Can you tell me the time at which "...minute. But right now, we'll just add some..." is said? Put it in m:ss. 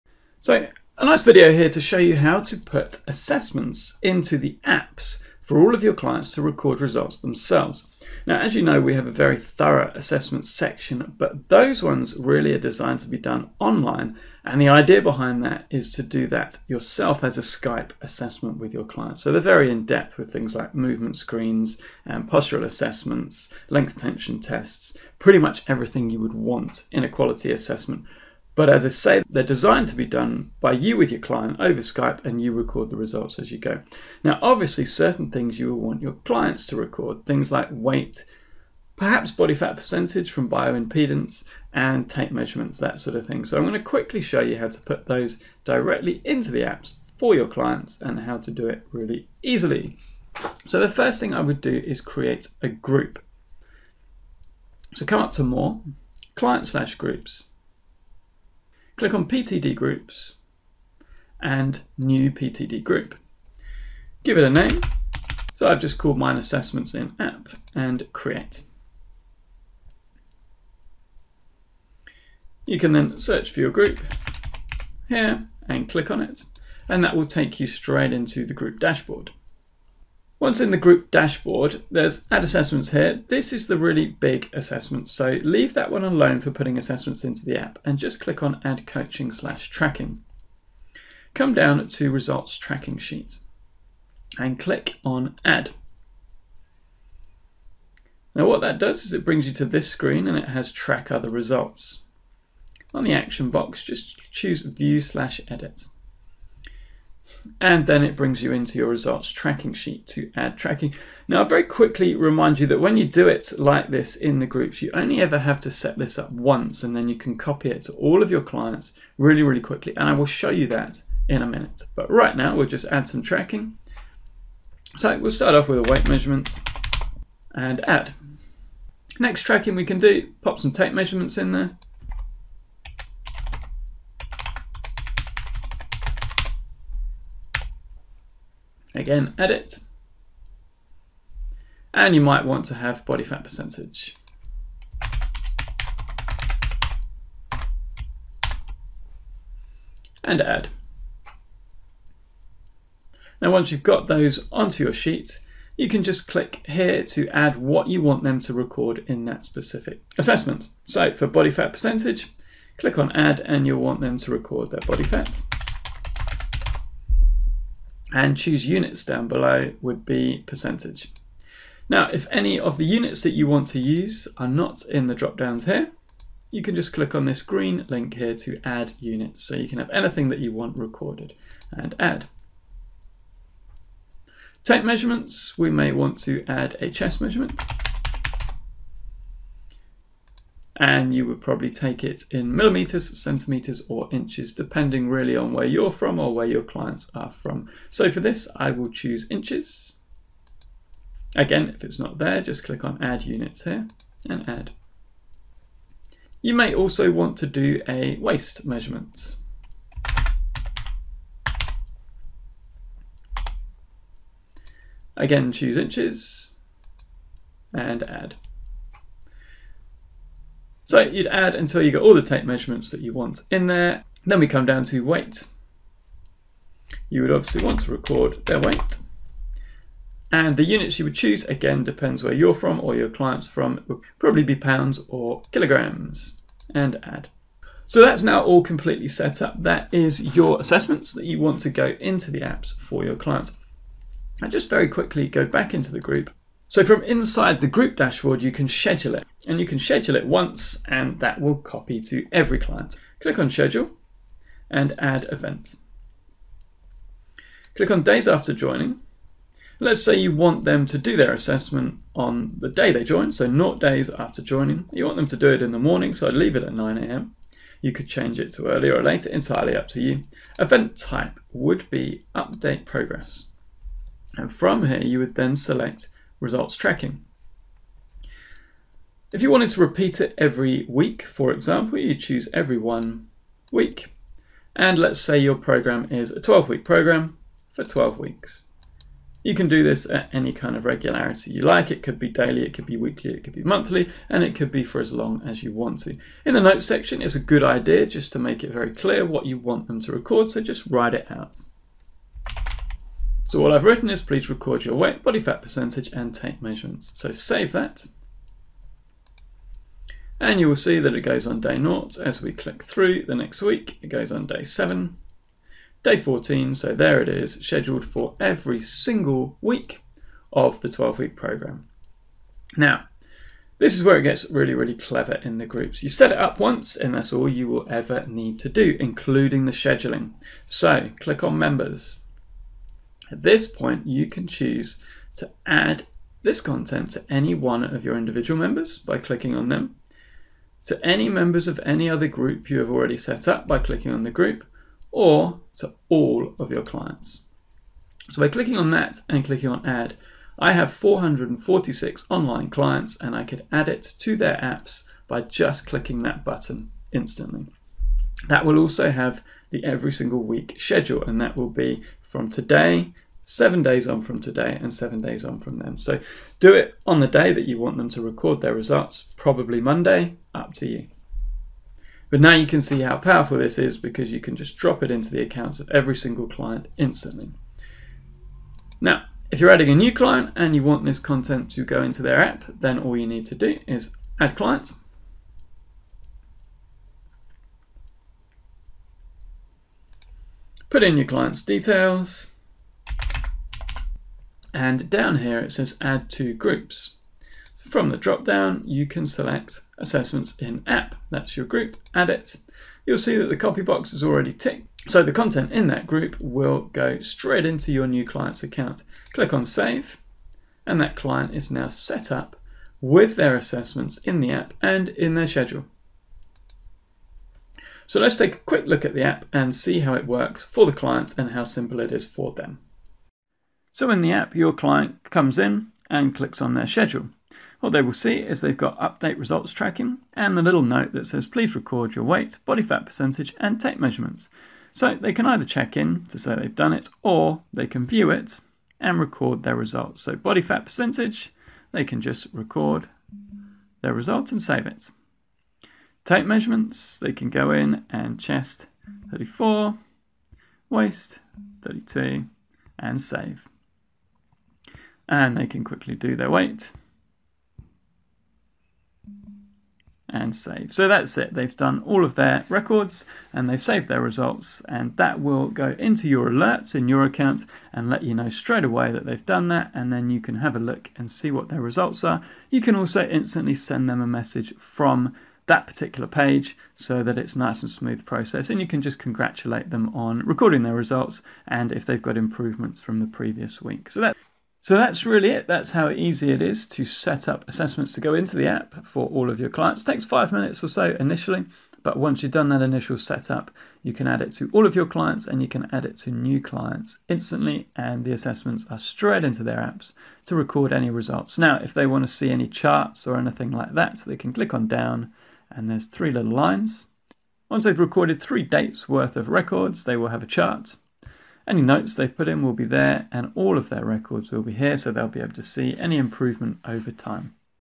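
2:01.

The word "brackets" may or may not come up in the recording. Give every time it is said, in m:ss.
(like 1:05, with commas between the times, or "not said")
not said.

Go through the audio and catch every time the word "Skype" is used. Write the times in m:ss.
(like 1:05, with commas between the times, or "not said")
0:17, 0:31.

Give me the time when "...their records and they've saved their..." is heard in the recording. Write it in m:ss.
7:42.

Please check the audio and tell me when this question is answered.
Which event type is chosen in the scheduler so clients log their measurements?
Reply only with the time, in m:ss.
4:32.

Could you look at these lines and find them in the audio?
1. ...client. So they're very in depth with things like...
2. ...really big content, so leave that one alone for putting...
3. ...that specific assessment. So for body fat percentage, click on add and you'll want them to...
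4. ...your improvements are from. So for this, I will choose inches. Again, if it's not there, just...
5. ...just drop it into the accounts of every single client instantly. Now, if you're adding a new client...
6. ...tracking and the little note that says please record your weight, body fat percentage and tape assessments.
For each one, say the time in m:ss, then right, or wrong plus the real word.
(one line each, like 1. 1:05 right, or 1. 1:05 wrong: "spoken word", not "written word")
1. 0:18 right
2. 1:23 wrong: "assessment", not "content"
3. 2:39 right
4. 3:16 wrong: "clients", not "improvements"
5. 6:14 right
6. 7:09 wrong: "measurements", not "assessments".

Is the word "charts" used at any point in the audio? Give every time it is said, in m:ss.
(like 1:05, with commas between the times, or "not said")
8:22, 8:30.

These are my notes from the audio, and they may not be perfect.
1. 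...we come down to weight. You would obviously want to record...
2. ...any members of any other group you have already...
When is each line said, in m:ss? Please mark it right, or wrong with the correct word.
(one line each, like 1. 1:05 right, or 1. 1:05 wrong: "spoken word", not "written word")
1. 3:44 right
2. 5:41 right.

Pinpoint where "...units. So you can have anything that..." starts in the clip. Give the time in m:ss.
2:58.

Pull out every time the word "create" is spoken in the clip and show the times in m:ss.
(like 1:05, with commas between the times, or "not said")
0:52, 1:08.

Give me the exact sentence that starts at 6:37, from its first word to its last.
So from the drop down, you can select assessments in app.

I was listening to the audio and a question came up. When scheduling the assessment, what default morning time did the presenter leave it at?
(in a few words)
9 a.m.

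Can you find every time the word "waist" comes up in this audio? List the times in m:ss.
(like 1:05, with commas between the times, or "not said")
3:28, 7:30.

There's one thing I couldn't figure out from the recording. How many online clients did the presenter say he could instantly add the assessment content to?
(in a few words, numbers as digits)
446.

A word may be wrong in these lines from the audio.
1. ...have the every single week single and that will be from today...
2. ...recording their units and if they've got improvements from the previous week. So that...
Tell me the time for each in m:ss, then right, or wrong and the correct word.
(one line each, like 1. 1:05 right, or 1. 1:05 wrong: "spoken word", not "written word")
1. 5:59 wrong: "schedule", not "single"
2. 8:00 wrong: "results", not "units".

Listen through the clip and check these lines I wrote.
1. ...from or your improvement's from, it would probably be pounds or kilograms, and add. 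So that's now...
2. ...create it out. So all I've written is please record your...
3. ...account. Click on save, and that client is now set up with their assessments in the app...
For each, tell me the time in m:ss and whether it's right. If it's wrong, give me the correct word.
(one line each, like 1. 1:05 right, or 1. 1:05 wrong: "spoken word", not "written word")
1. 3:52 wrong: "client", not "improvement"
2. 5:00 wrong: "write", not "create"
3. 6:48 right.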